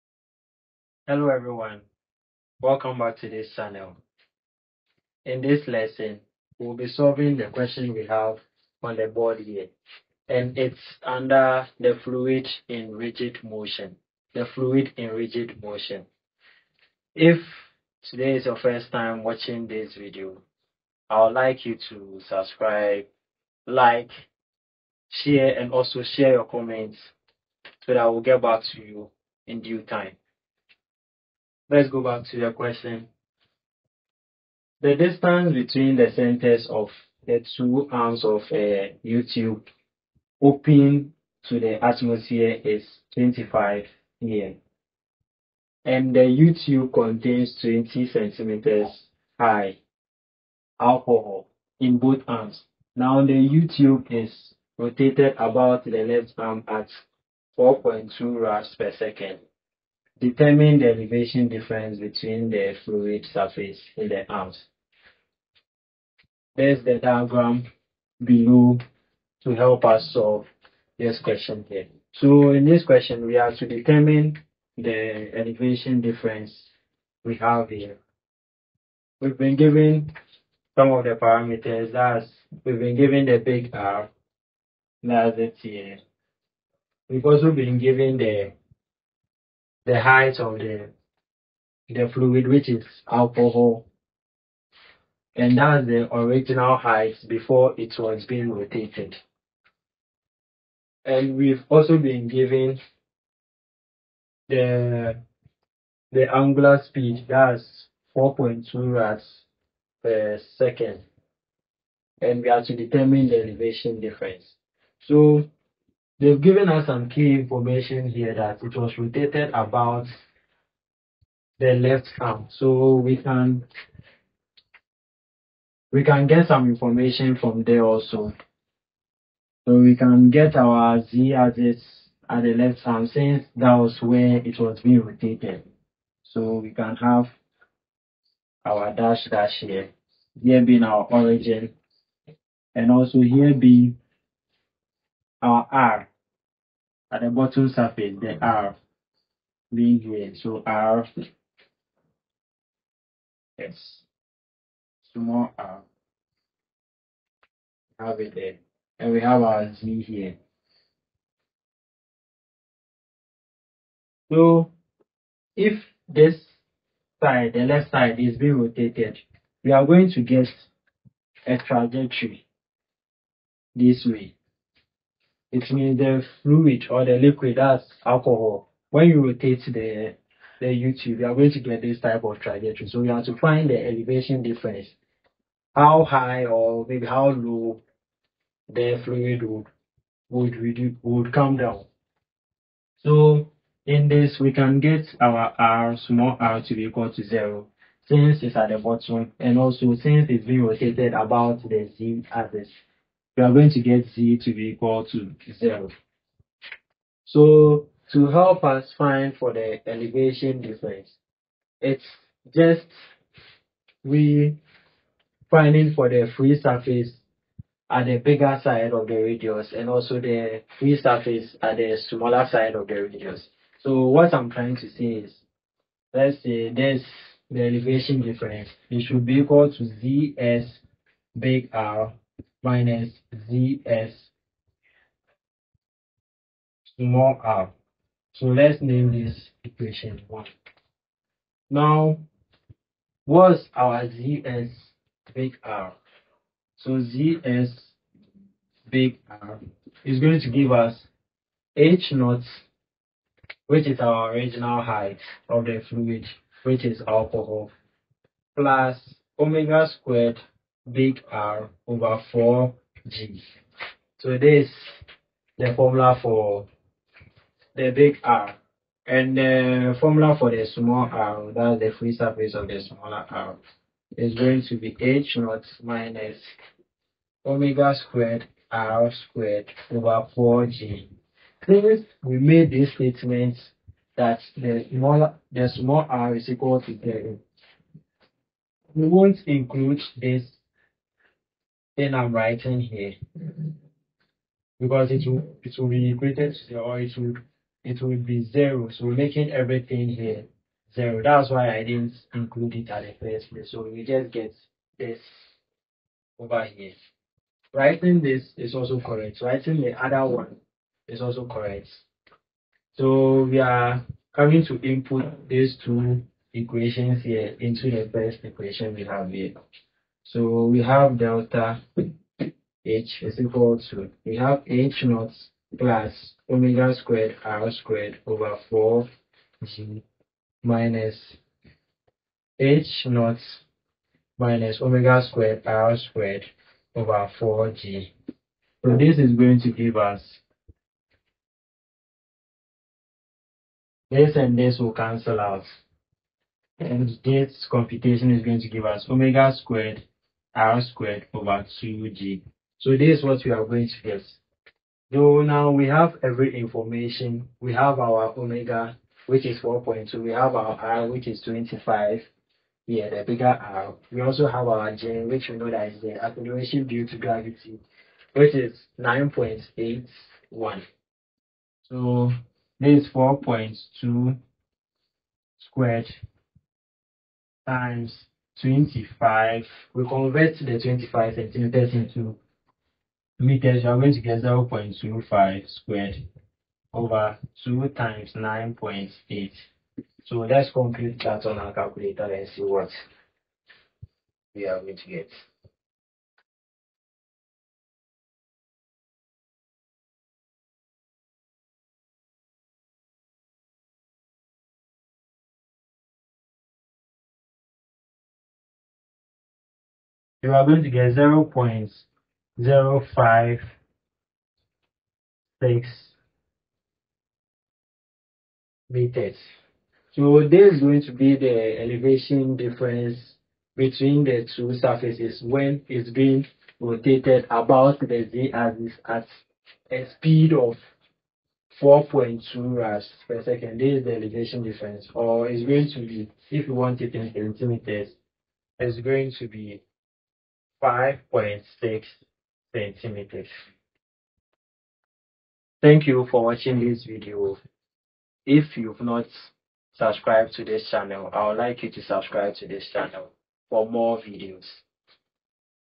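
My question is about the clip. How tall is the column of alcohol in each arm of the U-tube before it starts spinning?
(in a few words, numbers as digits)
20 centimeters.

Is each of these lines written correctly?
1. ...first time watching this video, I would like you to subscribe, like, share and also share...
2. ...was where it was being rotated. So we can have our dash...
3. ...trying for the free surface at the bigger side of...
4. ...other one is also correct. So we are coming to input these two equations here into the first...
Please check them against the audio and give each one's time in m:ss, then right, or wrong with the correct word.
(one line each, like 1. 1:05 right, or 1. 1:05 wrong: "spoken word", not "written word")
1. 0:18 right
2. 2:13 right
3. 3:35 wrong: "finding", not "trying"
4. 5:10 right.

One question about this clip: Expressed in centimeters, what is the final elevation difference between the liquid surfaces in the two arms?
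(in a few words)
5.6 centimeters.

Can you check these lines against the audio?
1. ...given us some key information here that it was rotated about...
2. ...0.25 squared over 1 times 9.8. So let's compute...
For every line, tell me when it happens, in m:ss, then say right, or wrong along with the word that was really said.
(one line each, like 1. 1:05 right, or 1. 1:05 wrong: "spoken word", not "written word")
1. 1:56 right
2. 6:24 wrong: "2", not "1".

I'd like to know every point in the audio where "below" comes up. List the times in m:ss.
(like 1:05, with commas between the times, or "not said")
1:08.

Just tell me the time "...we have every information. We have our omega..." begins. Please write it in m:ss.
5:55.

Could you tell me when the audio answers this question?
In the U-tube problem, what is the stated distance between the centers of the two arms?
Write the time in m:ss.
0:43.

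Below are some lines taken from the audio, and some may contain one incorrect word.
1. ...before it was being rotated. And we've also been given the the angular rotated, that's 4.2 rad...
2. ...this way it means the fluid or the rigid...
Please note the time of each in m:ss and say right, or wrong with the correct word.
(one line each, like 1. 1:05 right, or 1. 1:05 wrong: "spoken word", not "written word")
1. 1:37 wrong: "speed", not "rotated"
2. 2:53 wrong: "liquid", not "rigid".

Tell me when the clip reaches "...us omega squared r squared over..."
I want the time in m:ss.
5:48.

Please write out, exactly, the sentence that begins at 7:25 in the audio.
Thank you for watching this video.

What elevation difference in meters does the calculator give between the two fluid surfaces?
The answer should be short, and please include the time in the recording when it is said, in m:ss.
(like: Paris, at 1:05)
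0.056 meters, at 6:51.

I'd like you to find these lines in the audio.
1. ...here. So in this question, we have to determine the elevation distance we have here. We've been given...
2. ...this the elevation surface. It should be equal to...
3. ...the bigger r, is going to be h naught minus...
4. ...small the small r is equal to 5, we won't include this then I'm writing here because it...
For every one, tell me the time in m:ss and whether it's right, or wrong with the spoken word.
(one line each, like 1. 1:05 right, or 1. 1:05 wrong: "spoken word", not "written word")
1. 1:11 wrong: "difference", not "distance"
2. 3:46 wrong: "difference", not "surface"
3. 4:32 wrong: "smaller", not "bigger"
4. 4:44 wrong: "0", not "5".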